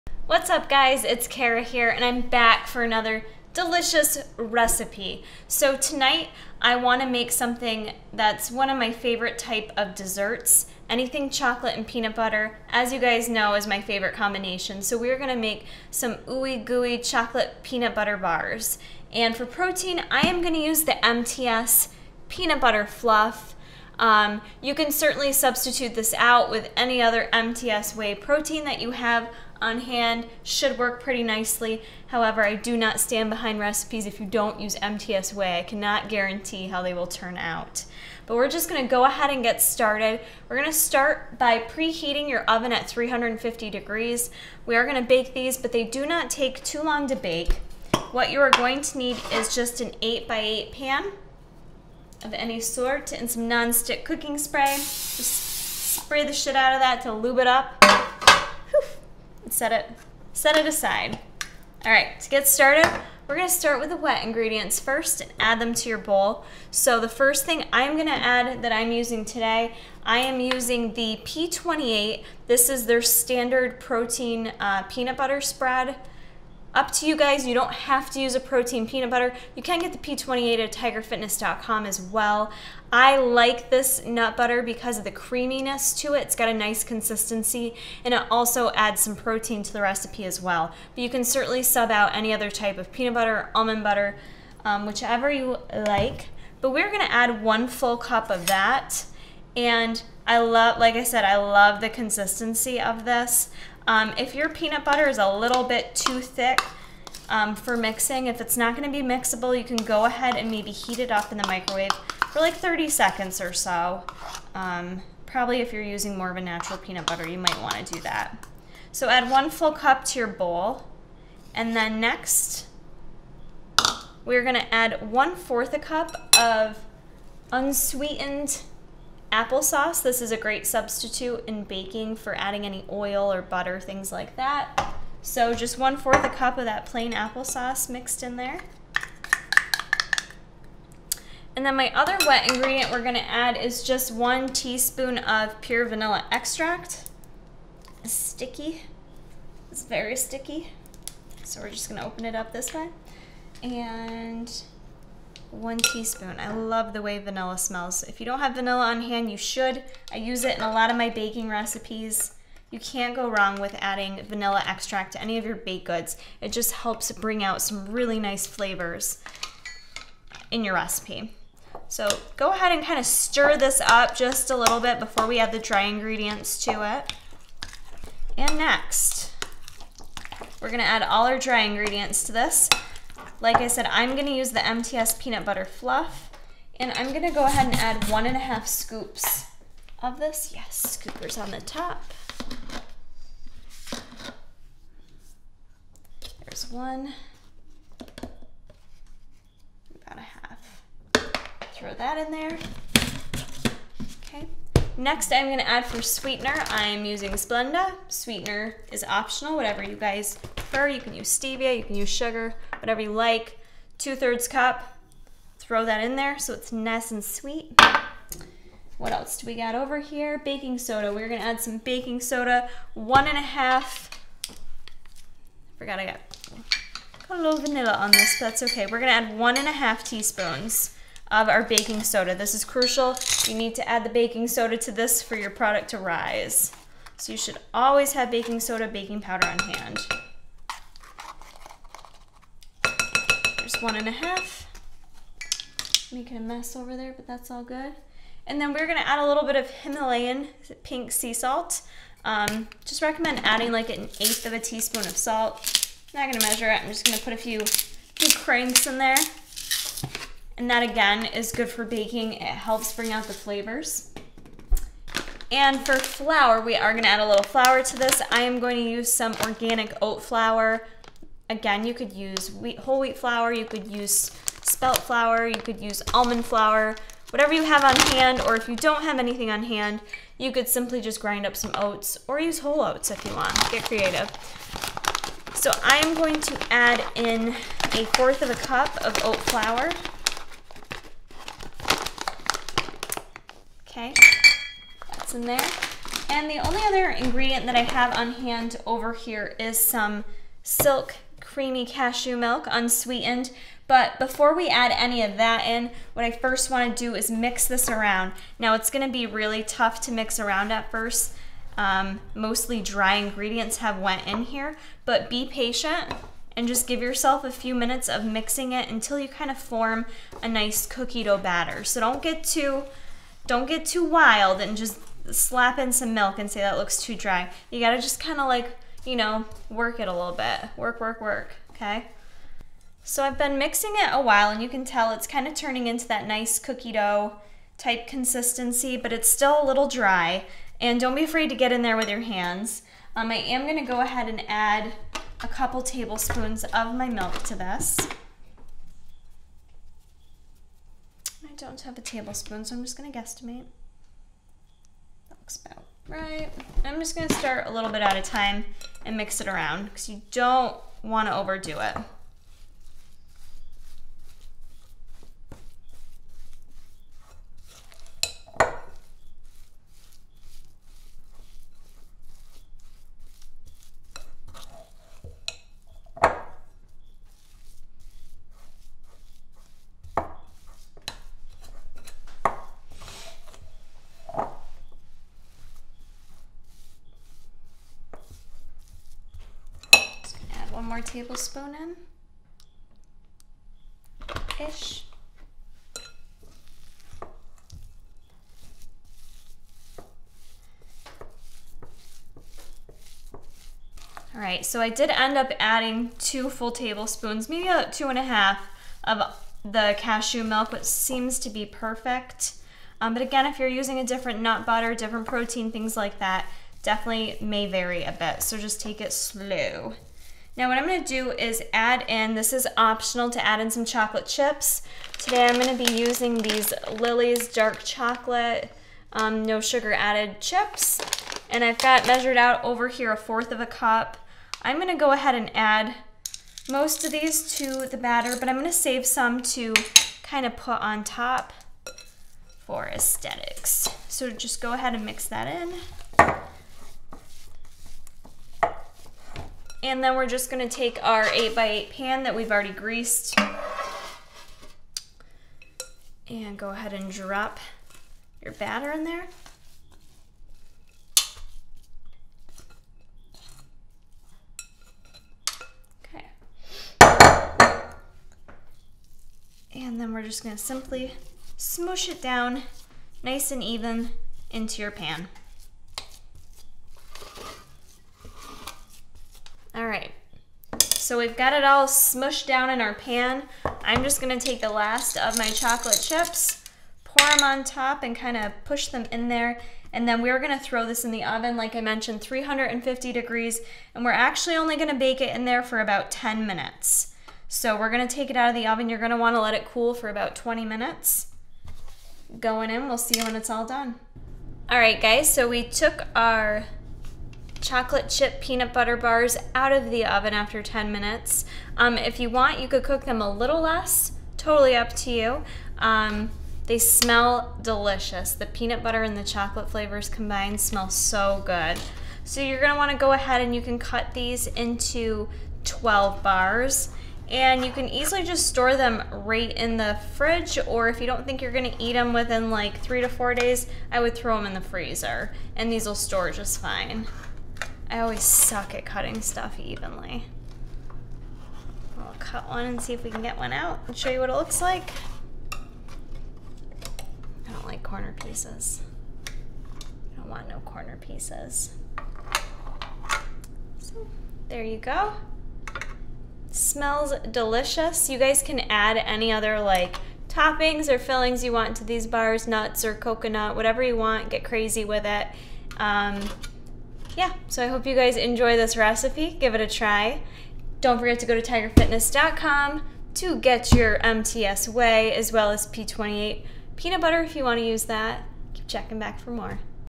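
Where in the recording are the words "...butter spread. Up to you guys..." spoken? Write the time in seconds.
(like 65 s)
75 s.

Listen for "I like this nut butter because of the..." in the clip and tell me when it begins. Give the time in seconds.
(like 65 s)
82 s.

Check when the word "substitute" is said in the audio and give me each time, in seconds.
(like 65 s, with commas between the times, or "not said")
25 s, 130 s.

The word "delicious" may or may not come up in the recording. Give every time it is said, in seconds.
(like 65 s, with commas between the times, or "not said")
3 s, 517 s, 557 s.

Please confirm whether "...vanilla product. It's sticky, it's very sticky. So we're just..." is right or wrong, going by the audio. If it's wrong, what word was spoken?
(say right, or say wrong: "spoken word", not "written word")
wrong: "extract", not "product".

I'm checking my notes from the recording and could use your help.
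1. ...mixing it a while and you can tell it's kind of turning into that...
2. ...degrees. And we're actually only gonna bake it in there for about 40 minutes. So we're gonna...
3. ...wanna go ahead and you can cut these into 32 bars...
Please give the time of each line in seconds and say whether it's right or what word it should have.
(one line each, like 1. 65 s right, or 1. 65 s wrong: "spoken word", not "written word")
1. 333 s right
2. 493 s wrong: "10", not "40"
3. 522 s wrong: "12", not "32".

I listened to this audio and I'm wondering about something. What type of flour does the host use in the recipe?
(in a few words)
Organic oat flour.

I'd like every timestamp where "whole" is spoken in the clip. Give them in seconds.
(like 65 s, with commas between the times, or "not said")
272 s, 282 s.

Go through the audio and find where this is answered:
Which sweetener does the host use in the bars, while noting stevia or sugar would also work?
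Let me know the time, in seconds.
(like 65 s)
207 s.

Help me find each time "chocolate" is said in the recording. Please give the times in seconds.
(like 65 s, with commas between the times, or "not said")
11 s, 16 s, 423 s, 427 s, 485 s, 507 s, 519 s.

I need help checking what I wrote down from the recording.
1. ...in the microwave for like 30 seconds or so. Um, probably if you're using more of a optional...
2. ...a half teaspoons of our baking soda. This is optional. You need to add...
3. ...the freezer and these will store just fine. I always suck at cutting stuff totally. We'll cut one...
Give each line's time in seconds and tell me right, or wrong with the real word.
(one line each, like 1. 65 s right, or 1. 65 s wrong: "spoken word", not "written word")
1. 111 s wrong: "natural", not "optional"
2. 229 s wrong: "crucial", not "optional"
3. 534 s wrong: "evenly", not "totally".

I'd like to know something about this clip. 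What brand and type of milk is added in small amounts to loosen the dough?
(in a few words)
Silk creamy cashew milk.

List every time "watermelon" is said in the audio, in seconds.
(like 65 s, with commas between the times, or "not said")
not said.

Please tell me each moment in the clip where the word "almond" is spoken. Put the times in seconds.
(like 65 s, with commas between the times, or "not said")
93 s, 276 s.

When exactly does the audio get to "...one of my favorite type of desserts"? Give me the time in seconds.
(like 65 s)
8 s.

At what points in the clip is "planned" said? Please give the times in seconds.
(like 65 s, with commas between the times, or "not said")
not said.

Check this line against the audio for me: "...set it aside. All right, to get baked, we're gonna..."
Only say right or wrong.
wrong.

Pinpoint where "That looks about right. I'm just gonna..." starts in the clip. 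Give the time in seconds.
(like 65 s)
355 s.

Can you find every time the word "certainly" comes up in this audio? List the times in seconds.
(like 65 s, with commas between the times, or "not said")
24 s, 91 s.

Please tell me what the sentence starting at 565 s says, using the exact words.
Um, yeah, so I hope you guys enjoy this recipe.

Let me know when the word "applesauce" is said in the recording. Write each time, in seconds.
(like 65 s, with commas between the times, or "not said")
129 s, 137 s.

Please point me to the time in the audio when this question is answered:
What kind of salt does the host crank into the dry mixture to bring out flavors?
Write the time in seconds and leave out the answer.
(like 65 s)
249 s.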